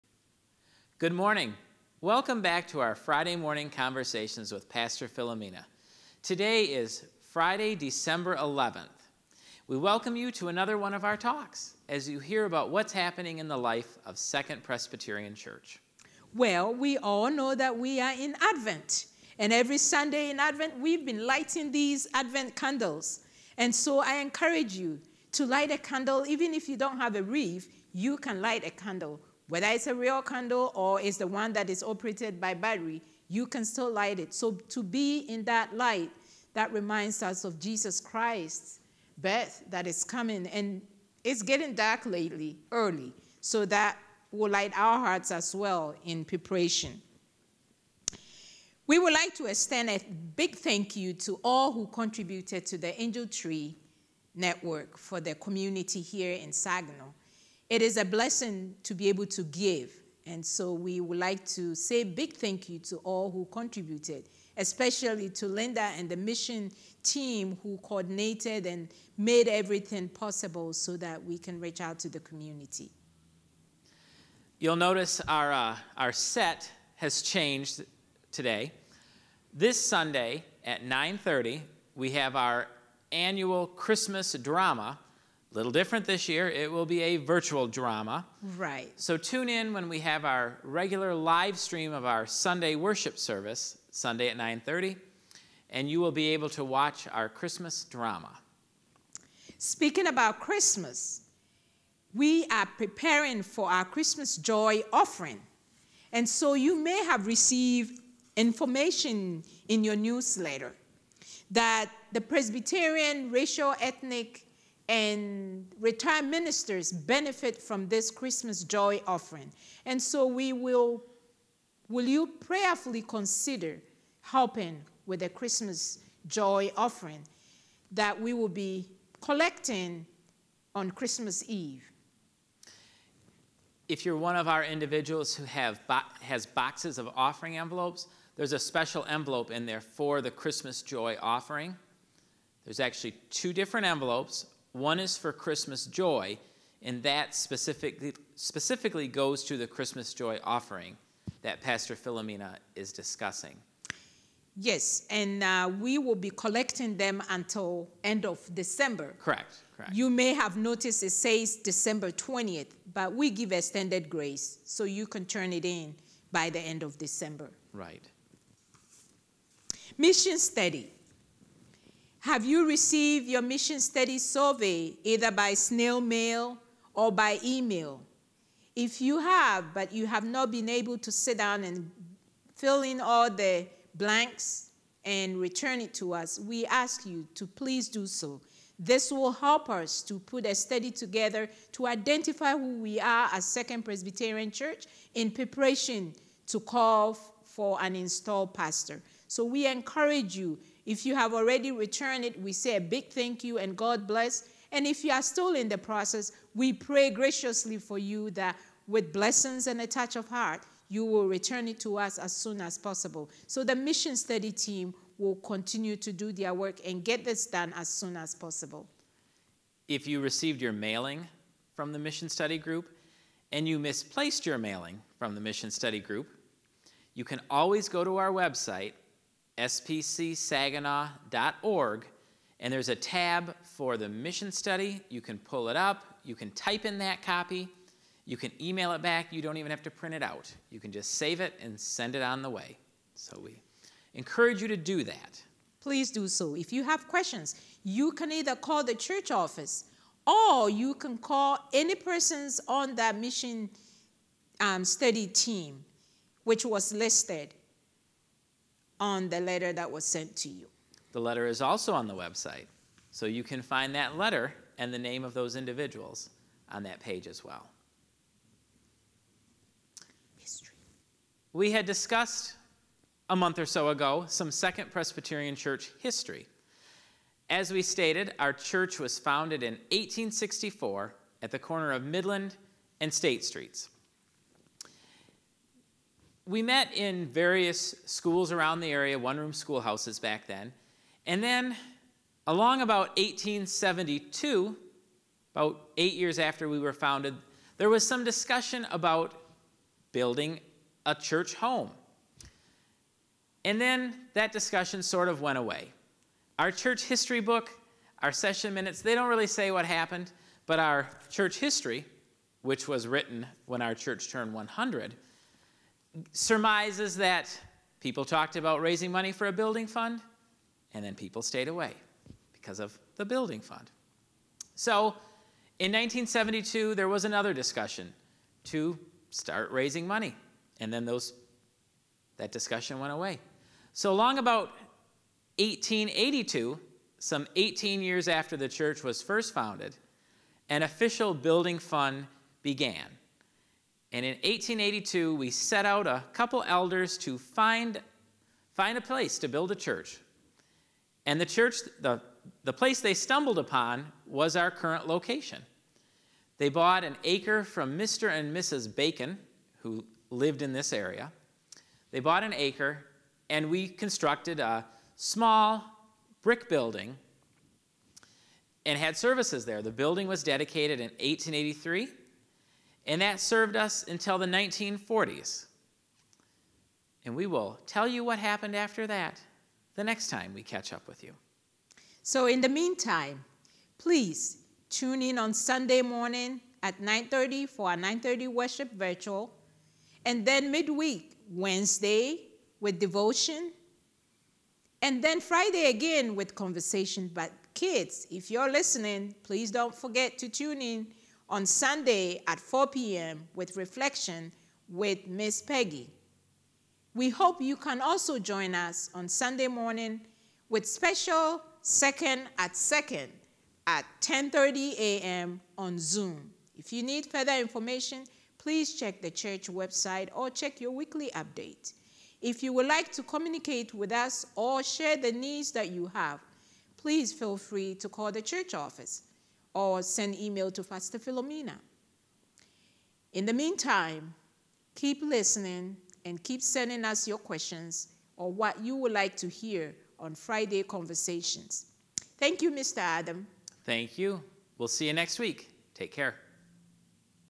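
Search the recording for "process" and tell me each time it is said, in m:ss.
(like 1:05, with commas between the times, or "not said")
3:25.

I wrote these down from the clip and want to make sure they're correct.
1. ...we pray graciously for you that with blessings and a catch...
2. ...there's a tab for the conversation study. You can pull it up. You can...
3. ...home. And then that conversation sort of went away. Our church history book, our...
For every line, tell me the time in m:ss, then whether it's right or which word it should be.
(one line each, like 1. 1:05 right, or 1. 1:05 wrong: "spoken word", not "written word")
1. 3:26 wrong: "touch", not "catch"
2. 3:52 wrong: "mission", not "conversation"
3. 5:01 wrong: "discussion", not "conversation".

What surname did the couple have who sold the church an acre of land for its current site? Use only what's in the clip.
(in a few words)
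Bacon.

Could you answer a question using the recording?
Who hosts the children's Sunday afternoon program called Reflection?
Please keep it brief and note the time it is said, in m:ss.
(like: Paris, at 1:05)
Miss Peggy, at 6:45.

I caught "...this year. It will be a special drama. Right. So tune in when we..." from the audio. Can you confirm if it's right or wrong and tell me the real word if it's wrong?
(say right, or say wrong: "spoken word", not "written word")
wrong: "virtual", not "special".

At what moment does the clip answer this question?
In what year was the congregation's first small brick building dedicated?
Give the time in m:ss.
6:11.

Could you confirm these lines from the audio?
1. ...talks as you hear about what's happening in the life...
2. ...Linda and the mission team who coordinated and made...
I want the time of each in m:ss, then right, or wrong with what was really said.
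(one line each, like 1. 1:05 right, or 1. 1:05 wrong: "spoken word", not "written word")
1. 0:11 right
2. 1:05 right.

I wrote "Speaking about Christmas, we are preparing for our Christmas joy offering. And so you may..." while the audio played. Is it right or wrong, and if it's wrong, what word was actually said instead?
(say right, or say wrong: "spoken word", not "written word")
right.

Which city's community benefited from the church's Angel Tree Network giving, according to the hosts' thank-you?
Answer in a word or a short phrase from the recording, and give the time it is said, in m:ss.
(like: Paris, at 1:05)
Saginaw, at 0:56.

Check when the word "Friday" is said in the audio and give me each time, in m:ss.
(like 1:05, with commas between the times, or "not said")
0:02, 0:07, 6:35, 7:20.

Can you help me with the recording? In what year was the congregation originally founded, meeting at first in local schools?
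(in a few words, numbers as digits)
1864.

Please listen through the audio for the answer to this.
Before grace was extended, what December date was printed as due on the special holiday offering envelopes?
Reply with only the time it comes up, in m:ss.
2:41.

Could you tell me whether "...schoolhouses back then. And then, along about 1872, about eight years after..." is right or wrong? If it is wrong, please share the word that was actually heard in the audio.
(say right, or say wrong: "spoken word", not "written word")
right.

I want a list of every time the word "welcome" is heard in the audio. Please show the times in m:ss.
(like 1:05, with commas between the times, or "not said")
0:02, 0:09.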